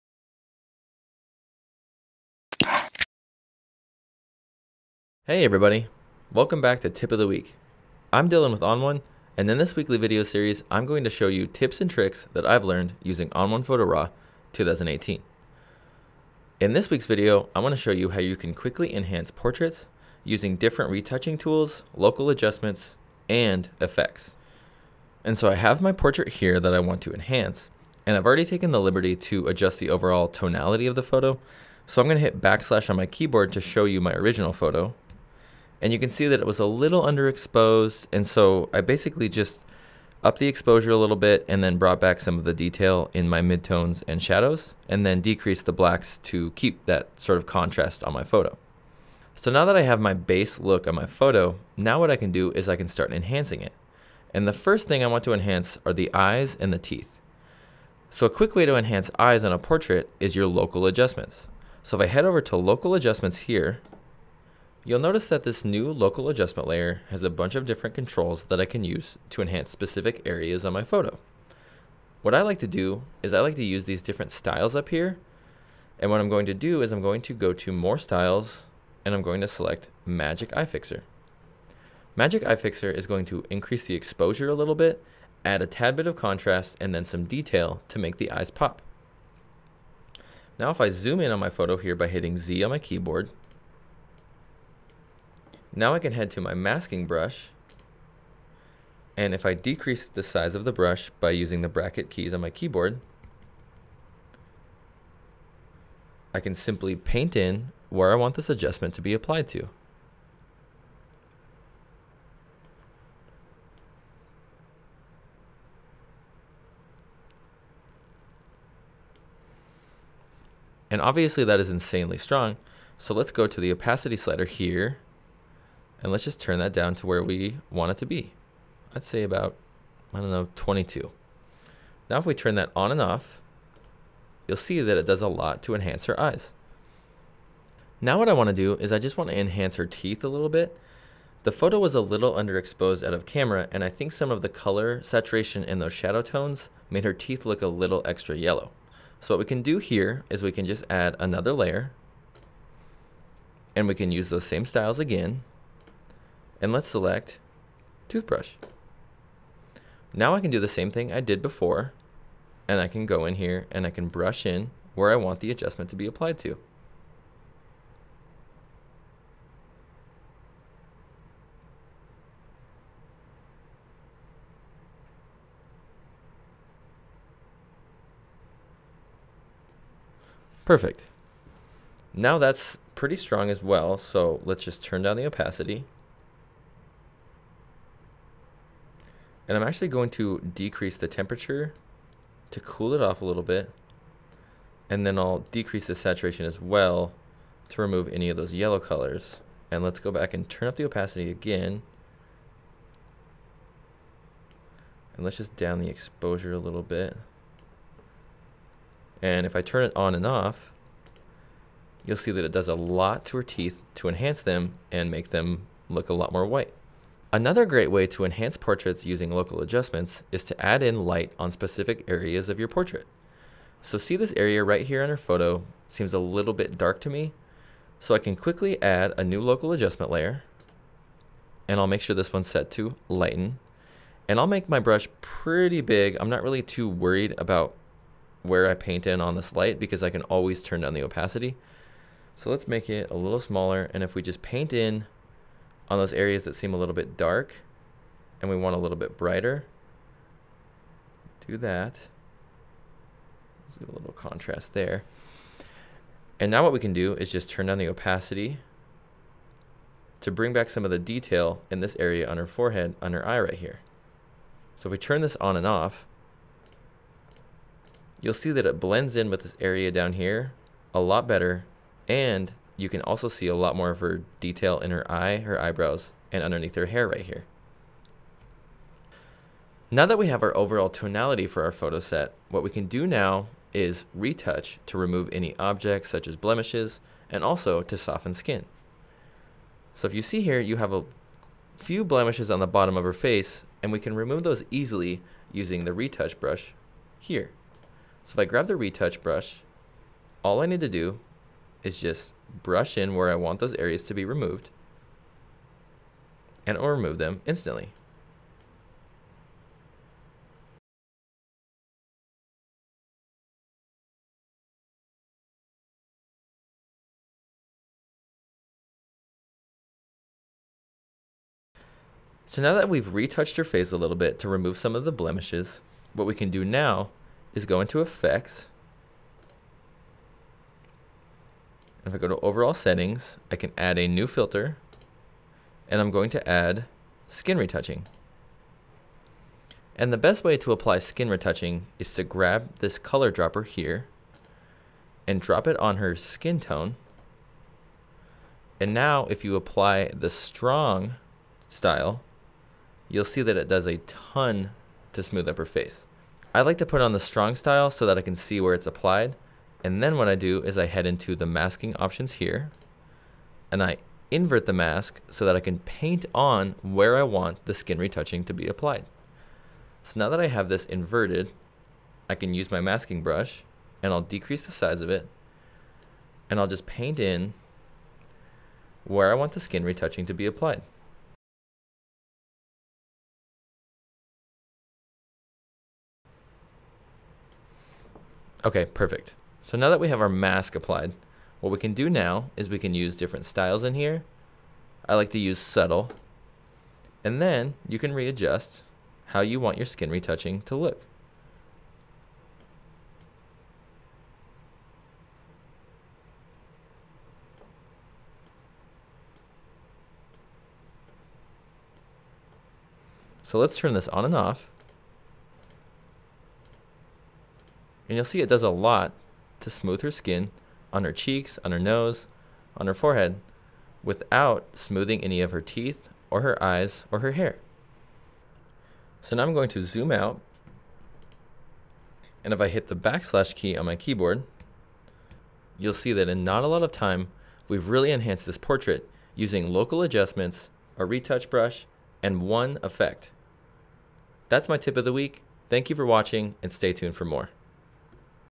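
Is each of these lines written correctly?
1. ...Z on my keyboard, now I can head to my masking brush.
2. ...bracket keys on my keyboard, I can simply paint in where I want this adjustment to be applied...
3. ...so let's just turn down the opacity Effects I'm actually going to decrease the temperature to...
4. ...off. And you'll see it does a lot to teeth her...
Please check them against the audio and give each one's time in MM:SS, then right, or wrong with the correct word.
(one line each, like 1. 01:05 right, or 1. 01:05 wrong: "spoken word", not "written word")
1. 01:32 right
2. 01:41 right
3. 03:03 wrong: "And", not "Effects"
4. 06:54 wrong: "smooth", not "teeth".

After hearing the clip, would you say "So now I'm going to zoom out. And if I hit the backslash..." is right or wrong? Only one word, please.
right.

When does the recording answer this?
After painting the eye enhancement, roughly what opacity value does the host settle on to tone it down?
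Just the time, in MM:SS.
02:10.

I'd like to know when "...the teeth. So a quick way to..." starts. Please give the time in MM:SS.
00:56.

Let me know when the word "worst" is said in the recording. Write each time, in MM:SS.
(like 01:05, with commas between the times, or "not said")
not said.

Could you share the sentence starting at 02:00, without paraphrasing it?
And obviously that is insanely strong.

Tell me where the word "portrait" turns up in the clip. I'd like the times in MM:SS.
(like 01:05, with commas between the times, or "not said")
00:19, 00:25, 00:59, 03:38, 03:42, 07:18.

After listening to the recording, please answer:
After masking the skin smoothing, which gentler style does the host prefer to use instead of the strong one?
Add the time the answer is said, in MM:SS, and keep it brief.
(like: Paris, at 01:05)
Subtle, at 06:35.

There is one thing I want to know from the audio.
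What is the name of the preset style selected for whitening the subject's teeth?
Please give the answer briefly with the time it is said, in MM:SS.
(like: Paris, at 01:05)
Toothbrush, at 02:38.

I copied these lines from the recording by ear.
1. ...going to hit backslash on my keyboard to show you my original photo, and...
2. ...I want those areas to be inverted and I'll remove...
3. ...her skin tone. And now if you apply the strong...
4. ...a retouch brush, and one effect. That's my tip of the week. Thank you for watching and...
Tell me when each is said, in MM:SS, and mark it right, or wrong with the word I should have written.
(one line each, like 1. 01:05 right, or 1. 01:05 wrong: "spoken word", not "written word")
1. 00:32 right
2. 05:03 wrong: "removed", not "inverted"
3. 05:45 right
4. 07:20 right.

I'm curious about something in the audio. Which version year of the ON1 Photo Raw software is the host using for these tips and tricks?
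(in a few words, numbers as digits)
2018.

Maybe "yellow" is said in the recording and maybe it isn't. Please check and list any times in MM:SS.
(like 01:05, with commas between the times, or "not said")
02:28, 03:18.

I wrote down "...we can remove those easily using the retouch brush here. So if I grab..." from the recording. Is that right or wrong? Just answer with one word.
right.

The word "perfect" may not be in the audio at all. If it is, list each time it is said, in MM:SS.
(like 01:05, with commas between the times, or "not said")
03:00, 06:28.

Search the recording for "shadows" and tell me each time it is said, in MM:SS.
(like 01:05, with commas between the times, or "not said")
00:44, 02:25.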